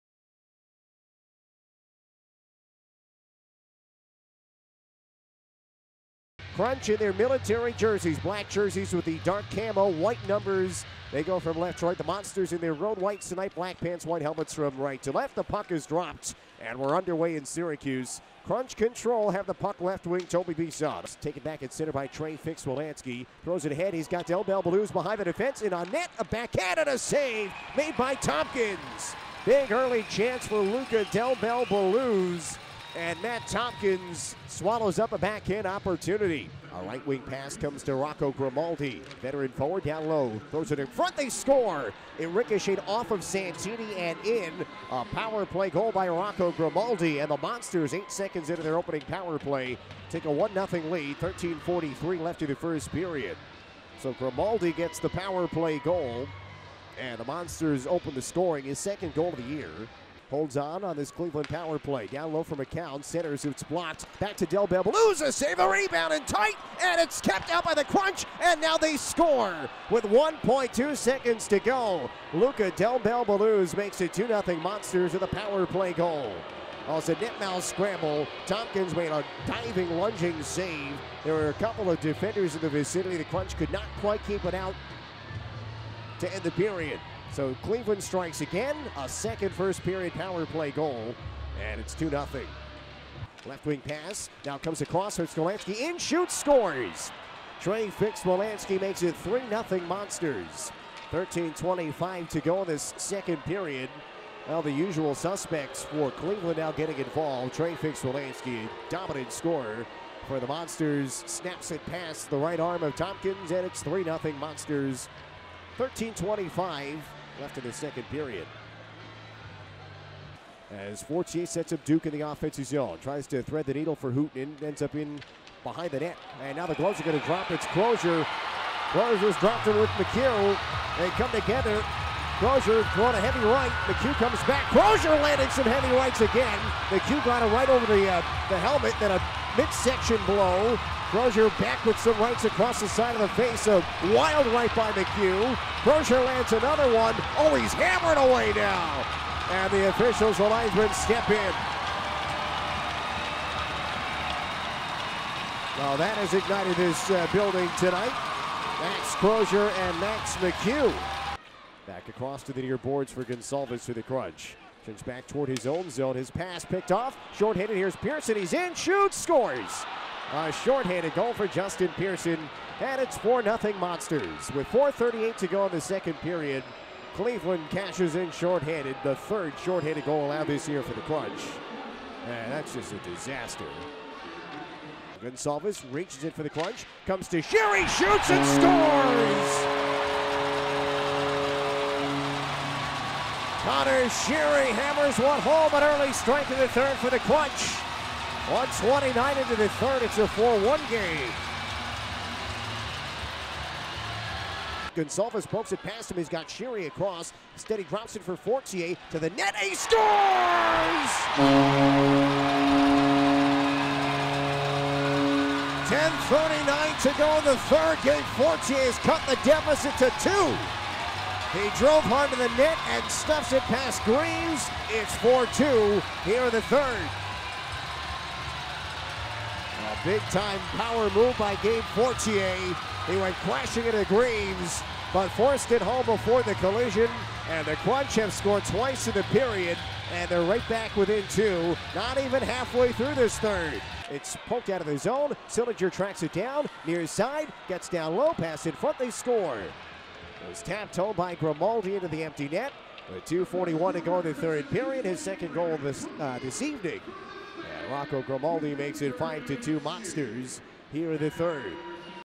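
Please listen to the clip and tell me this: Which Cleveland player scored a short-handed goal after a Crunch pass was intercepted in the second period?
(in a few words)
Justin Pearson.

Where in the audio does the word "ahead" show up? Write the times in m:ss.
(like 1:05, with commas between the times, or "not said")
0:23.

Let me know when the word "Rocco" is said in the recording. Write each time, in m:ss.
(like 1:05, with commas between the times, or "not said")
0:37, 0:46, 4:17.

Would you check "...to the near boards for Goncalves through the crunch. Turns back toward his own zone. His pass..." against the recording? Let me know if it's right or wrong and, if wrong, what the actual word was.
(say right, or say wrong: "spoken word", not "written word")
right.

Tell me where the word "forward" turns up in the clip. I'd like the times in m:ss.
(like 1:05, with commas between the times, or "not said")
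0:39.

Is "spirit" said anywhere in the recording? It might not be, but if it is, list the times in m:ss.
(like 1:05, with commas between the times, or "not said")
not said.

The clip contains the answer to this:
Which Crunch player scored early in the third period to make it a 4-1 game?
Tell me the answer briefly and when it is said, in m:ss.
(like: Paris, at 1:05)
Connor Sheary, at 3:13.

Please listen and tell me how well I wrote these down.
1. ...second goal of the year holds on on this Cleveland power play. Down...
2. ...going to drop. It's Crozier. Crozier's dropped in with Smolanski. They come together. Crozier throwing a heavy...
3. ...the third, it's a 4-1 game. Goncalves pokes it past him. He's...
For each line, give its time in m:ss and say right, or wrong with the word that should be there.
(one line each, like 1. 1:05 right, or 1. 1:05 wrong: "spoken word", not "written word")
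1. 0:58 right
2. 2:07 wrong: "McHugh", not "Smolanski"
3. 3:19 right.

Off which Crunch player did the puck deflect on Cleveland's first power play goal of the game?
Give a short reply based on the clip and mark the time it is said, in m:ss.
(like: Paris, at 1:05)
Santini, at 0:43.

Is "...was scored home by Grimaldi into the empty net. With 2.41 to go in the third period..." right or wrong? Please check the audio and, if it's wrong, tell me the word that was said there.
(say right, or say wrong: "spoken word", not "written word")
wrong: "tapped", not "scored".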